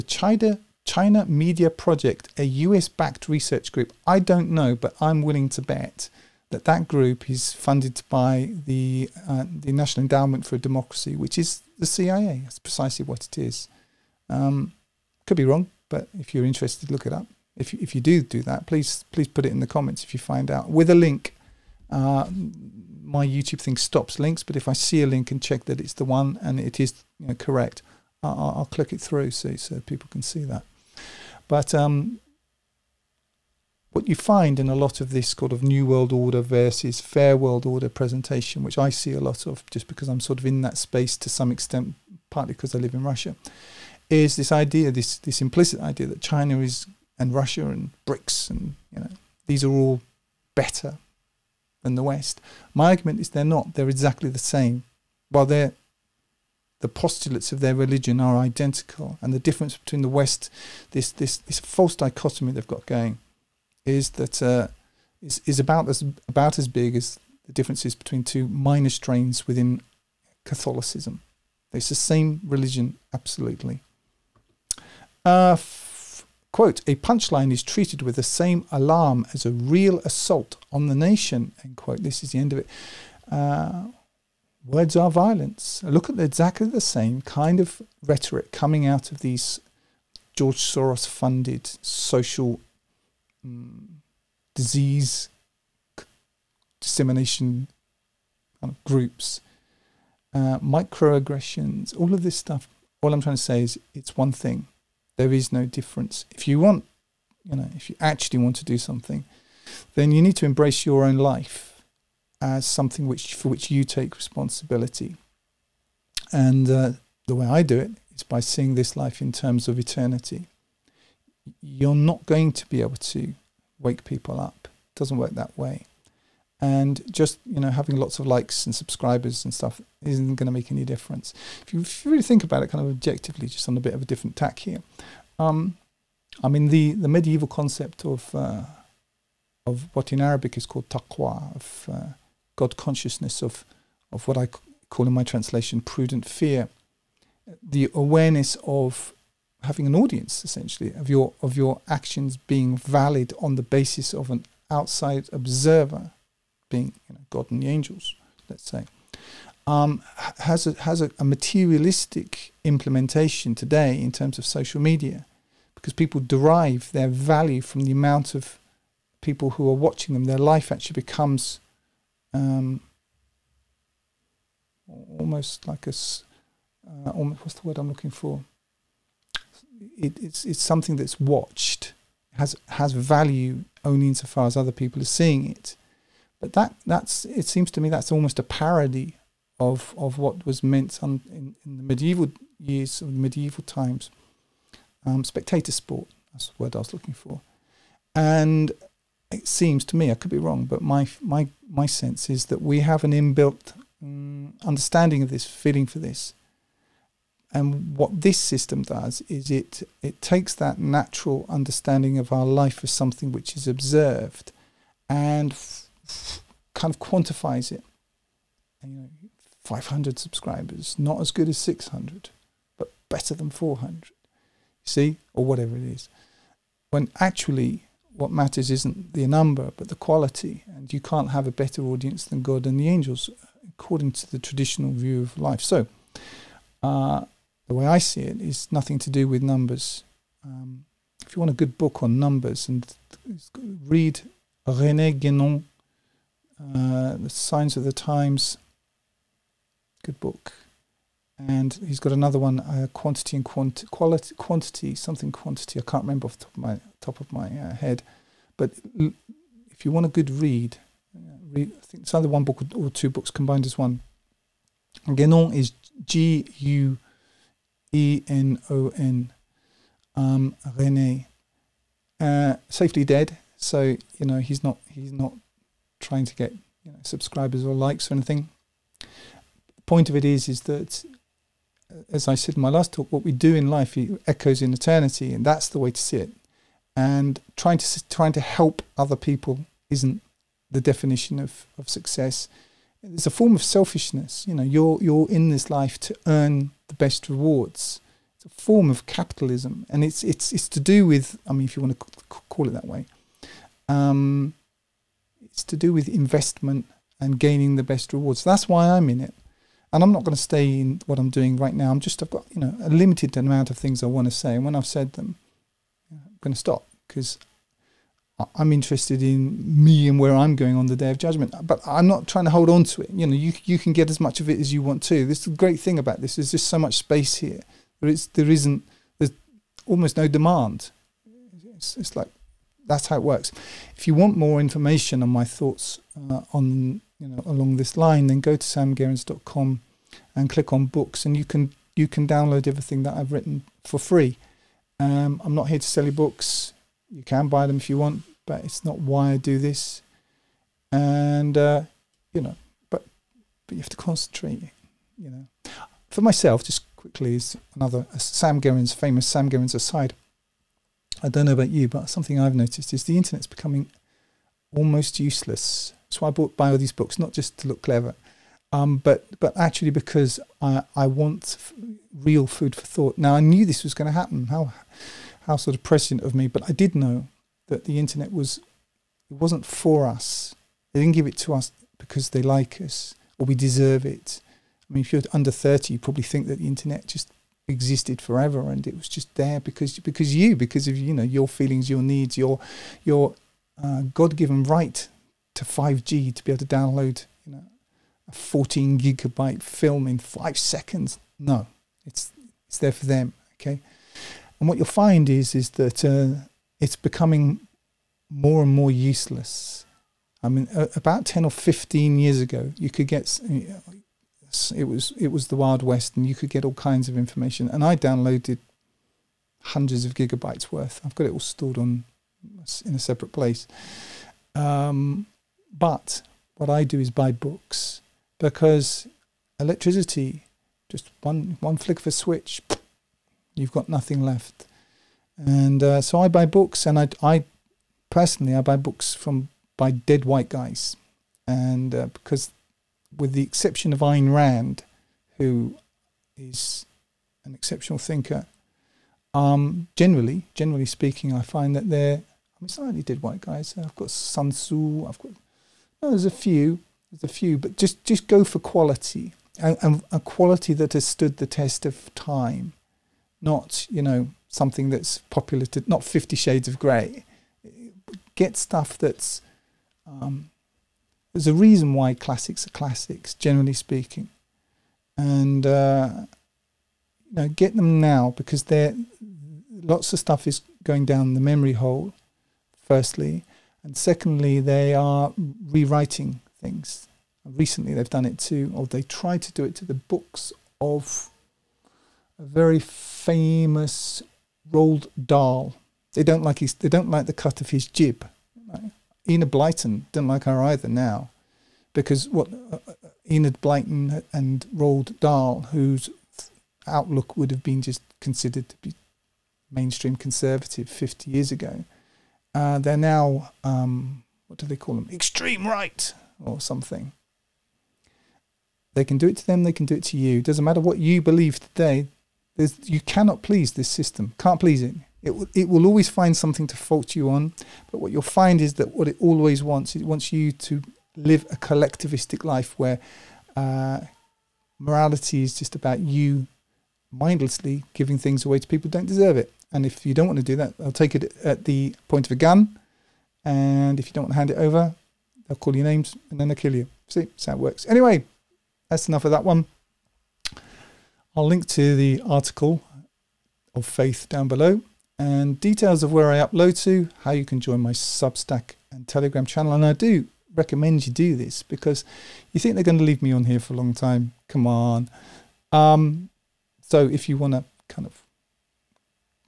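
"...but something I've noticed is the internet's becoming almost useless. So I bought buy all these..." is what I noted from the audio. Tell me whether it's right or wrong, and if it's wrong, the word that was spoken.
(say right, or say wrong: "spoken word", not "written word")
right.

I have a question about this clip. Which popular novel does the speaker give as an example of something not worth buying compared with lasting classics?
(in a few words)
Fifty Shades of Grey.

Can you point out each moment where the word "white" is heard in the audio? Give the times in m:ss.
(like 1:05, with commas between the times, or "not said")
7:20, 7:33.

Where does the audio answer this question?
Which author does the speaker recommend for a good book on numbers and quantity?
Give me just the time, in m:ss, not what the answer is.
4:04.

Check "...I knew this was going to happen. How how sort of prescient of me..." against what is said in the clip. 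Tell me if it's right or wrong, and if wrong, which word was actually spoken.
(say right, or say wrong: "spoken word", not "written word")
right.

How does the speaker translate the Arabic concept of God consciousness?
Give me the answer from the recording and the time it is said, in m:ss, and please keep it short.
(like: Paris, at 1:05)
prudent fear, at 2:25.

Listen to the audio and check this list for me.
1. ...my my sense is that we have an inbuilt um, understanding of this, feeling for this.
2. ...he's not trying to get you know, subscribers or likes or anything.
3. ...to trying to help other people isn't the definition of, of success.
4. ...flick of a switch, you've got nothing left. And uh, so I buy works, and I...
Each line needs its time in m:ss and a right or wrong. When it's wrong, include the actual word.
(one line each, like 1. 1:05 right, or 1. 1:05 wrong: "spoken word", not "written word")
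1. 3:21 right
2. 4:34 right
3. 4:47 right
4. 7:11 wrong: "books", not "works".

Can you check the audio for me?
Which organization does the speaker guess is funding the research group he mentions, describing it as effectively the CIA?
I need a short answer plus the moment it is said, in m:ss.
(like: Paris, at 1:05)
National Endowment for Democracy, at 0:09.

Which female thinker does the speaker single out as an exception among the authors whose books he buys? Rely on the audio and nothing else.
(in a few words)
Ayn Rand.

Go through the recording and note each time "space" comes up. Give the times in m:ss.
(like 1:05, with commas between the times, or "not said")
0:40, 5:26.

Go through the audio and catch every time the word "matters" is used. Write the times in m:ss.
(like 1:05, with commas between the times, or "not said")
3:48, 8:40.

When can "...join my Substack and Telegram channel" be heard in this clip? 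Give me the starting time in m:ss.
9:17.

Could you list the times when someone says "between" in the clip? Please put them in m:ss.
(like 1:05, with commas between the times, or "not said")
0:59, 1:07.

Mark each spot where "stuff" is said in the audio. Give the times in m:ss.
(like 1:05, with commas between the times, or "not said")
1:42, 2:09, 7:48, 8:00.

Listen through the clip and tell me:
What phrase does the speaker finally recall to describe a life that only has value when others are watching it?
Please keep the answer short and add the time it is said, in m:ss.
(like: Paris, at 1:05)
spectator sport, at 3:15.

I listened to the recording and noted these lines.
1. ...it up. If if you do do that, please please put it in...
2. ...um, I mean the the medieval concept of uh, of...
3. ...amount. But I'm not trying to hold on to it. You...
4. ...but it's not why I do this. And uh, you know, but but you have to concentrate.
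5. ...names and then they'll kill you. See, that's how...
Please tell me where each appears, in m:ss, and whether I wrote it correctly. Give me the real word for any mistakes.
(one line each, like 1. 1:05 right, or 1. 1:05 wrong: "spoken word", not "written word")
1. 0:17 right
2. 2:15 right
3. 5:21 wrong: "judgment", not "amount"
4. 5:48 right
5. 9:05 right.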